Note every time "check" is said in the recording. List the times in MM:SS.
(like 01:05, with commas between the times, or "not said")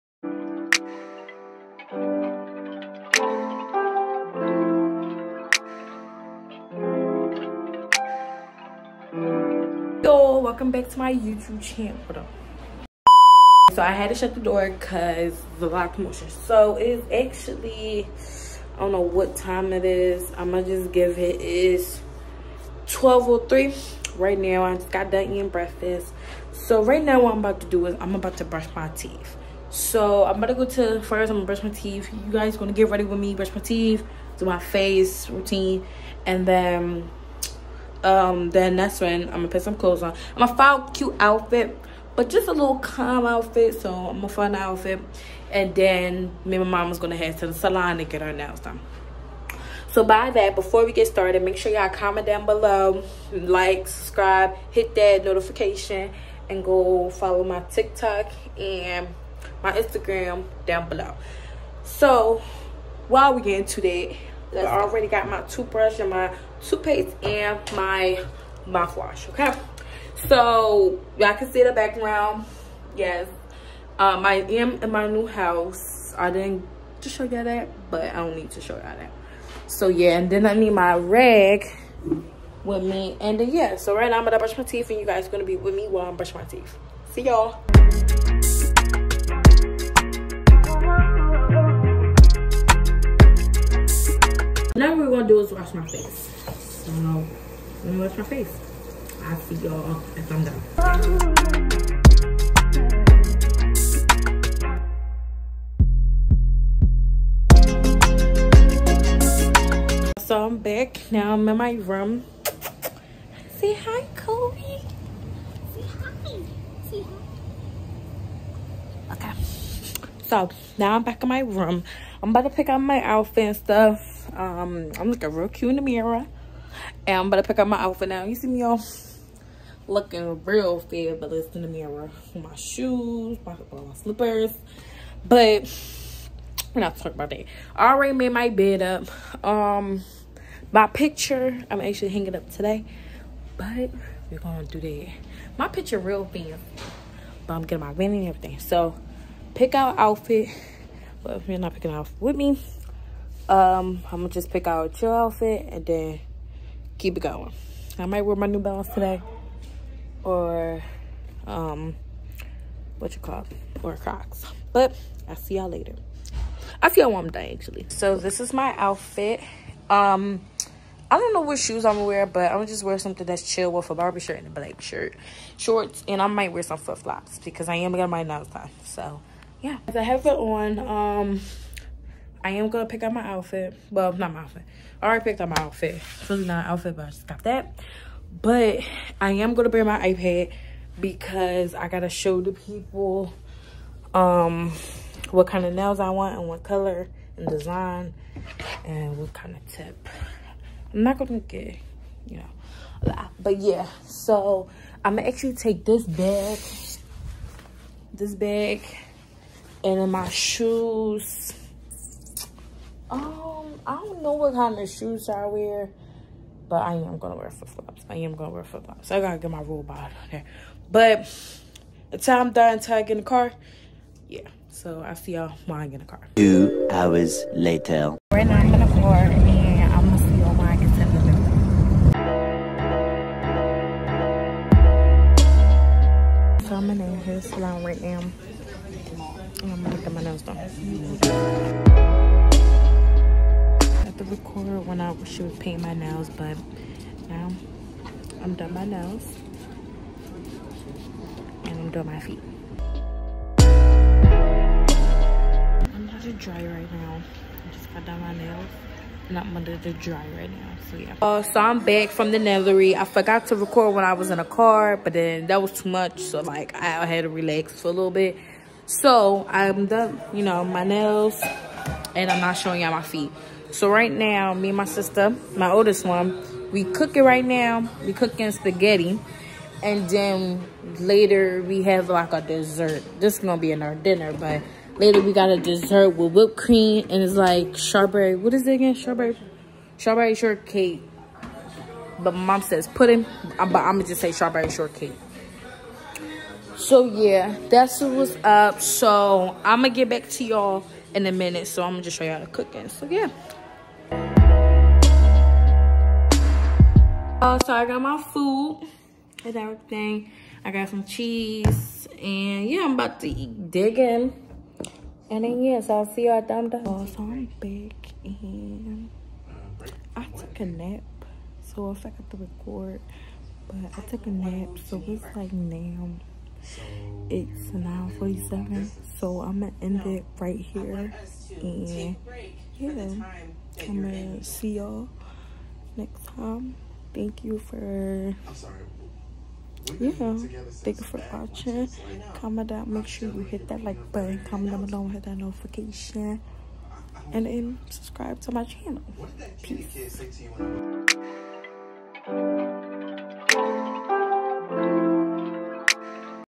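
not said.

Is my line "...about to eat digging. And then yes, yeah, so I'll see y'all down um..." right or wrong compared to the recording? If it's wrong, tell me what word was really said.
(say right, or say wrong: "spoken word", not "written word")
right.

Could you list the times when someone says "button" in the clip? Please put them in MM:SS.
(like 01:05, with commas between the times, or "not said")
05:44.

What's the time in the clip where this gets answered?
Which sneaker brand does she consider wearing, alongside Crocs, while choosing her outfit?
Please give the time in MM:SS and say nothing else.
02:38.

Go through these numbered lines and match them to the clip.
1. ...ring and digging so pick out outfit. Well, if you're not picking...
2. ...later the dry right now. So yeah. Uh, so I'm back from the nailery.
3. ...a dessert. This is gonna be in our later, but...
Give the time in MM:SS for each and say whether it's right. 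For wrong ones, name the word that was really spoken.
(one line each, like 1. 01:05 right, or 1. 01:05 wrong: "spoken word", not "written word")
1. 02:27 wrong: "everything", not "digging"
2. 04:19 wrong: "under", not "later"
3. 04:42 wrong: "dinner", not "later".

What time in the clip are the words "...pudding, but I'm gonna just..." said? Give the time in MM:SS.
04:52.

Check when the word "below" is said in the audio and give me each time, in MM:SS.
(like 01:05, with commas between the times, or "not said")
00:52, 01:00, 05:44.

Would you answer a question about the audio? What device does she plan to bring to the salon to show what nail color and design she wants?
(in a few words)
iPad.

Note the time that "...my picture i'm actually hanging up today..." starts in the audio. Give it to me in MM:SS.
02:20.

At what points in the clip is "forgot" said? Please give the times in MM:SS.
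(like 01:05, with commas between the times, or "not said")
04:23, 05:21.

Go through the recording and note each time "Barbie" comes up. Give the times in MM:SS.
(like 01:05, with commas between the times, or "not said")
02:53.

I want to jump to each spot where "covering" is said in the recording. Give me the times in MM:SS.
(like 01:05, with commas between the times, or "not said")
not said.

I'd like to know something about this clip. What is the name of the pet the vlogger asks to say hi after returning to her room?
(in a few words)
Kobe.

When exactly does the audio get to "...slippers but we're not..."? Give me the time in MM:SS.
02:13.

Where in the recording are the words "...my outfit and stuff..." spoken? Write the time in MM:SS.
02:02.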